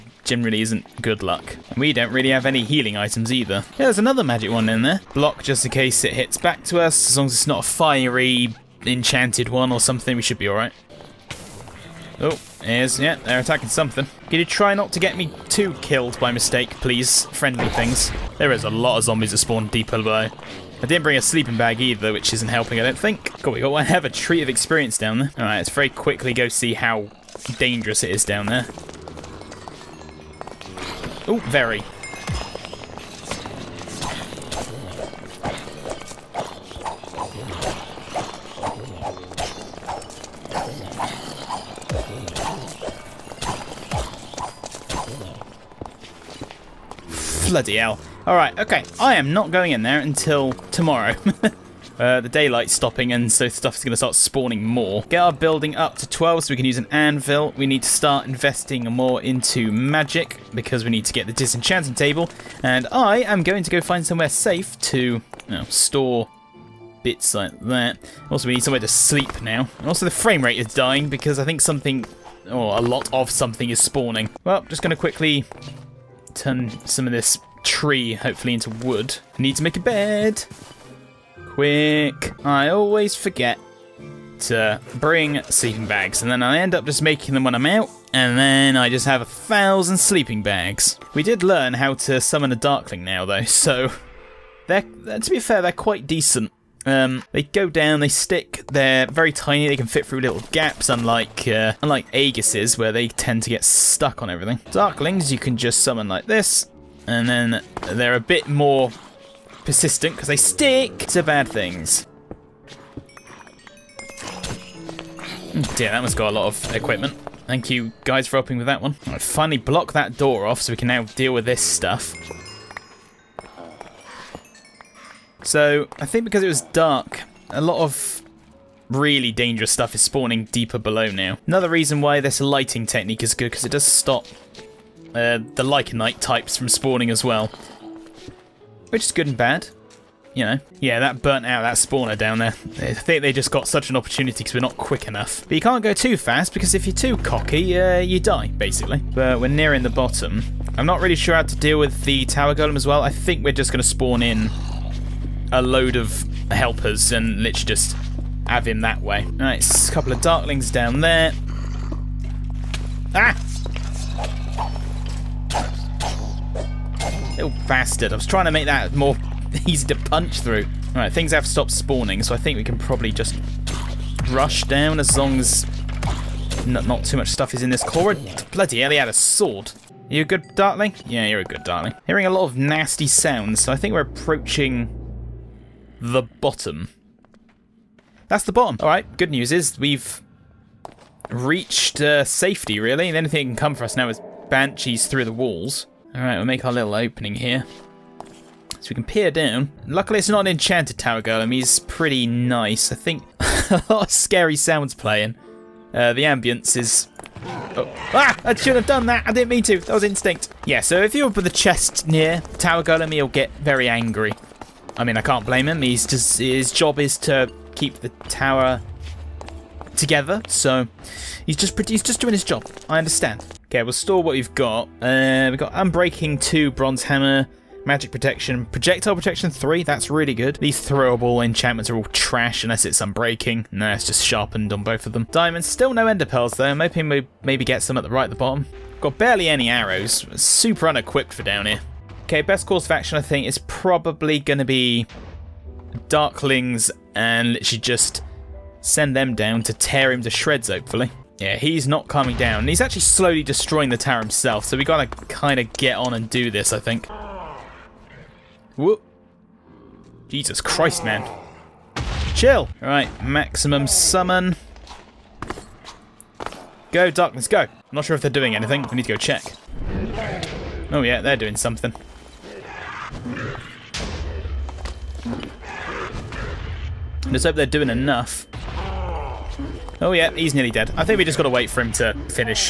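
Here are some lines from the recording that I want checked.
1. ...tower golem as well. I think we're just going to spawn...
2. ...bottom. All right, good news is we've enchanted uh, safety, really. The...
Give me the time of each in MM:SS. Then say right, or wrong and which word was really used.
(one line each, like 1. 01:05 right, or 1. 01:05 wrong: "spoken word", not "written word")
1. 02:32 right
2. 03:08 wrong: "reached", not "enchanted".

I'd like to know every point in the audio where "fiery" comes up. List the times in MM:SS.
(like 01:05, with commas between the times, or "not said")
00:07.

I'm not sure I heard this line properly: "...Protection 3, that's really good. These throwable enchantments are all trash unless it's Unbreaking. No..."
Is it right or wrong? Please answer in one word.
right.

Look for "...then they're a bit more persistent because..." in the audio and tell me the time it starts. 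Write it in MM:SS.
01:47.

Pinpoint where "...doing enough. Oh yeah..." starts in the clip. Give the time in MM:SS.
04:37.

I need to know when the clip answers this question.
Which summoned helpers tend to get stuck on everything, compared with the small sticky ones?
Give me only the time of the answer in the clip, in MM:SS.
01:42.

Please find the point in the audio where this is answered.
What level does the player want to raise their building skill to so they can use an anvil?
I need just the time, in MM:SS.
00:56.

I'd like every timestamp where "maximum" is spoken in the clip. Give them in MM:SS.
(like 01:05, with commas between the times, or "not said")
04:23.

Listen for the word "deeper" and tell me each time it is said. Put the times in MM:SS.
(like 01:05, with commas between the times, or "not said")
00:19, 02:10.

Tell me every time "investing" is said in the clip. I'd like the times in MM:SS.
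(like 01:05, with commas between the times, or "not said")
00:58.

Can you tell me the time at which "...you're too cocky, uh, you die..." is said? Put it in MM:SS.
02:26.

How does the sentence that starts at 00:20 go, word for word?
I didn't bring a sleeping bag either, which isn't helping, I don't think.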